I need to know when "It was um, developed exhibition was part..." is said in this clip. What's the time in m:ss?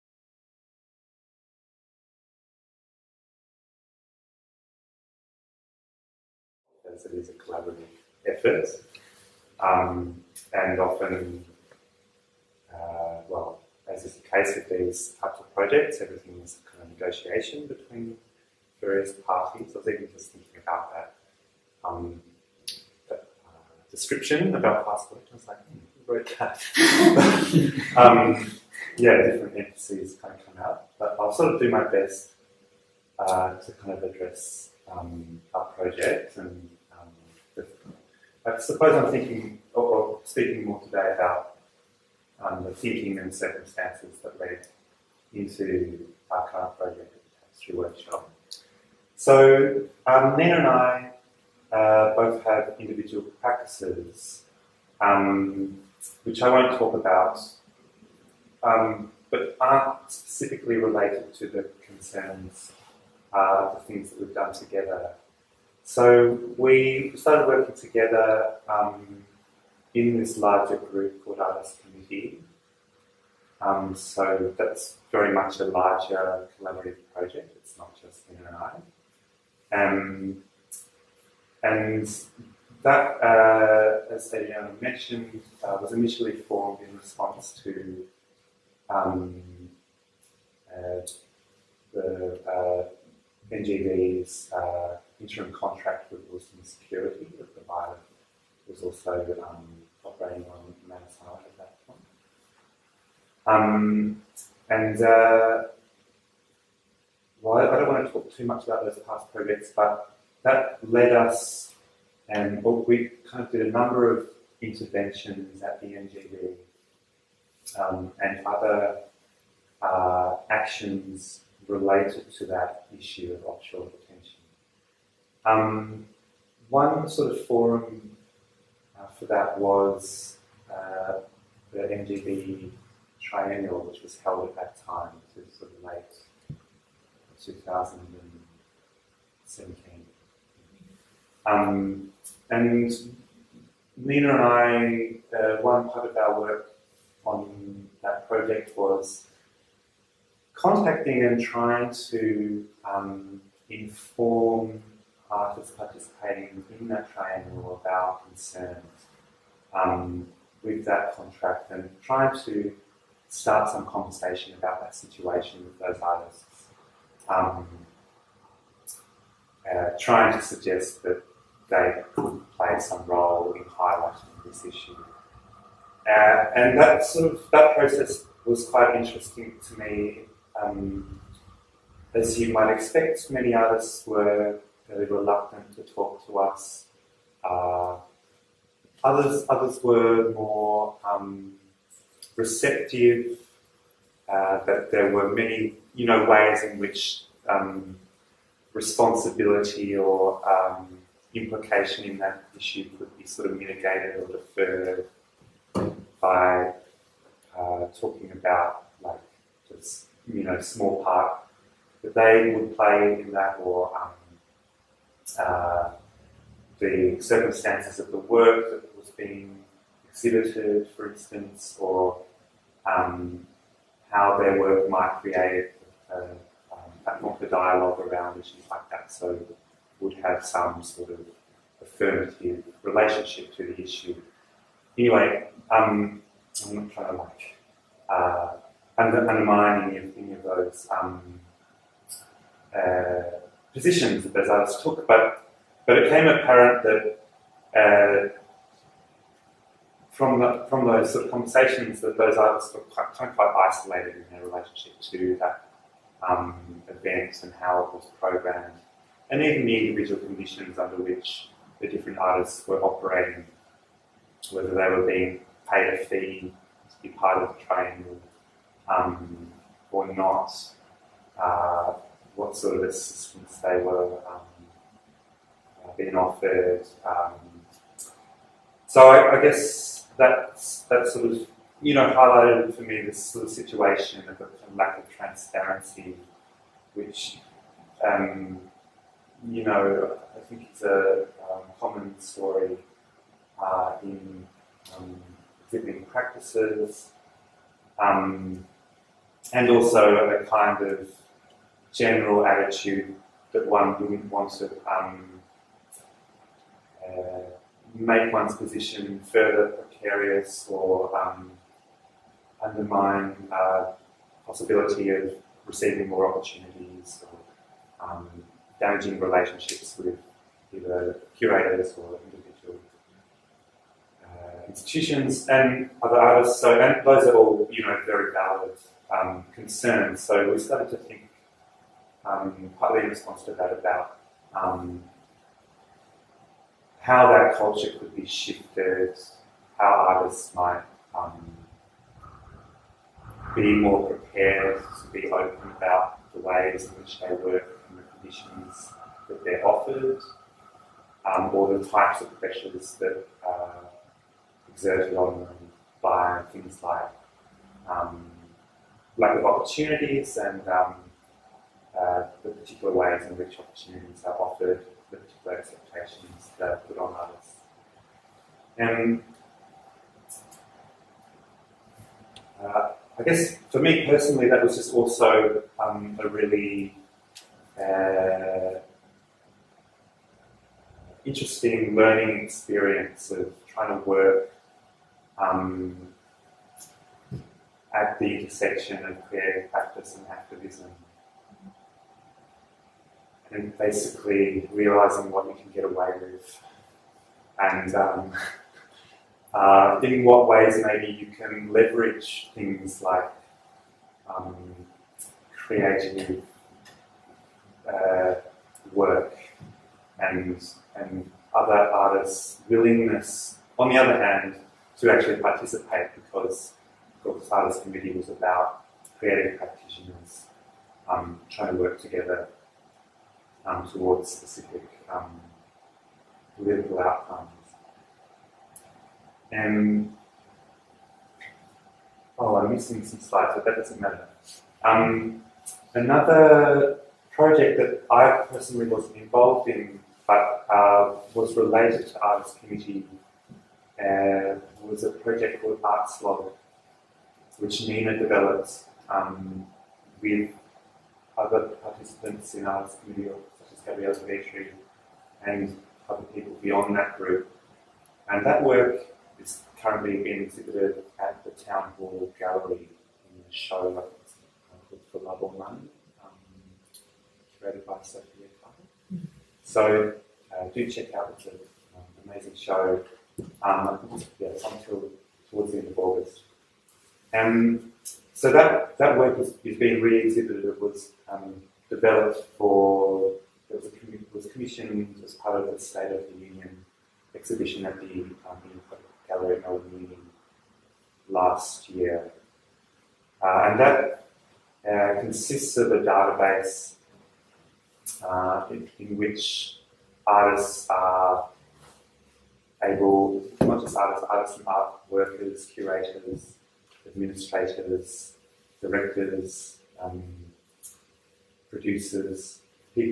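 8:00.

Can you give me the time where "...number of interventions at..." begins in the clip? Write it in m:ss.
1:53.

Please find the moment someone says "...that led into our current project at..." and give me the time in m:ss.
0:44.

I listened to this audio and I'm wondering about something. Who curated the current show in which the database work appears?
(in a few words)
Sophia Carter.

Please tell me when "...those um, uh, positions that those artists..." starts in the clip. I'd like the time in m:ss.
4:00.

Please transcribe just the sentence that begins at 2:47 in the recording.
Um, uh, trying to suggest that they could play some role in highlighting this issue.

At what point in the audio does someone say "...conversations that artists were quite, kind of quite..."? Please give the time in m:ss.
4:11.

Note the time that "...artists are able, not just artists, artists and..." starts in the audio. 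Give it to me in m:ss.
8:20.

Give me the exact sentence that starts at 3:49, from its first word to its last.
So would have some sort of affirmative relationship to the issue.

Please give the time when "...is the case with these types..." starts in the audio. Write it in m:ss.
0:14.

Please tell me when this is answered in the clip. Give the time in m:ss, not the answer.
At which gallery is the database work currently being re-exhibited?
7:41.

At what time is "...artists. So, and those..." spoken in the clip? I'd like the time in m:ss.
5:26.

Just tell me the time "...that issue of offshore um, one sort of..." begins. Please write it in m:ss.
2:02.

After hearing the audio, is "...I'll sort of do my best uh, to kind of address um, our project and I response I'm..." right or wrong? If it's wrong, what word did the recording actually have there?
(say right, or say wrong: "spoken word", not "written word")
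wrong: "suppose", not "response".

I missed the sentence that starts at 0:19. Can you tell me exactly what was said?
I was even just thinking about that, um, that uh, description about past I was like, hmm, who wrote that?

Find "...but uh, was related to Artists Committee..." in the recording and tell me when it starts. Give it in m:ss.
7:20.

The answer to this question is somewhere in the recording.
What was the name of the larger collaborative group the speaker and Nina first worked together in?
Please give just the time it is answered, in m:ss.
1:11.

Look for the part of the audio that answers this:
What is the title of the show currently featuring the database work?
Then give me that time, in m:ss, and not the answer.
7:45.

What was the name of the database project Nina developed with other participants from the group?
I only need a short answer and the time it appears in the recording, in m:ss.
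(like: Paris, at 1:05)
Arts Log, at 7:25.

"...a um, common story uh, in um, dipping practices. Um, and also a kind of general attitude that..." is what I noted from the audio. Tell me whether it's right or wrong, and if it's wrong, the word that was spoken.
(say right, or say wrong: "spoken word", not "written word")
right.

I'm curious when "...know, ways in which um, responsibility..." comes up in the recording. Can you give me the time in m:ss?
3:16.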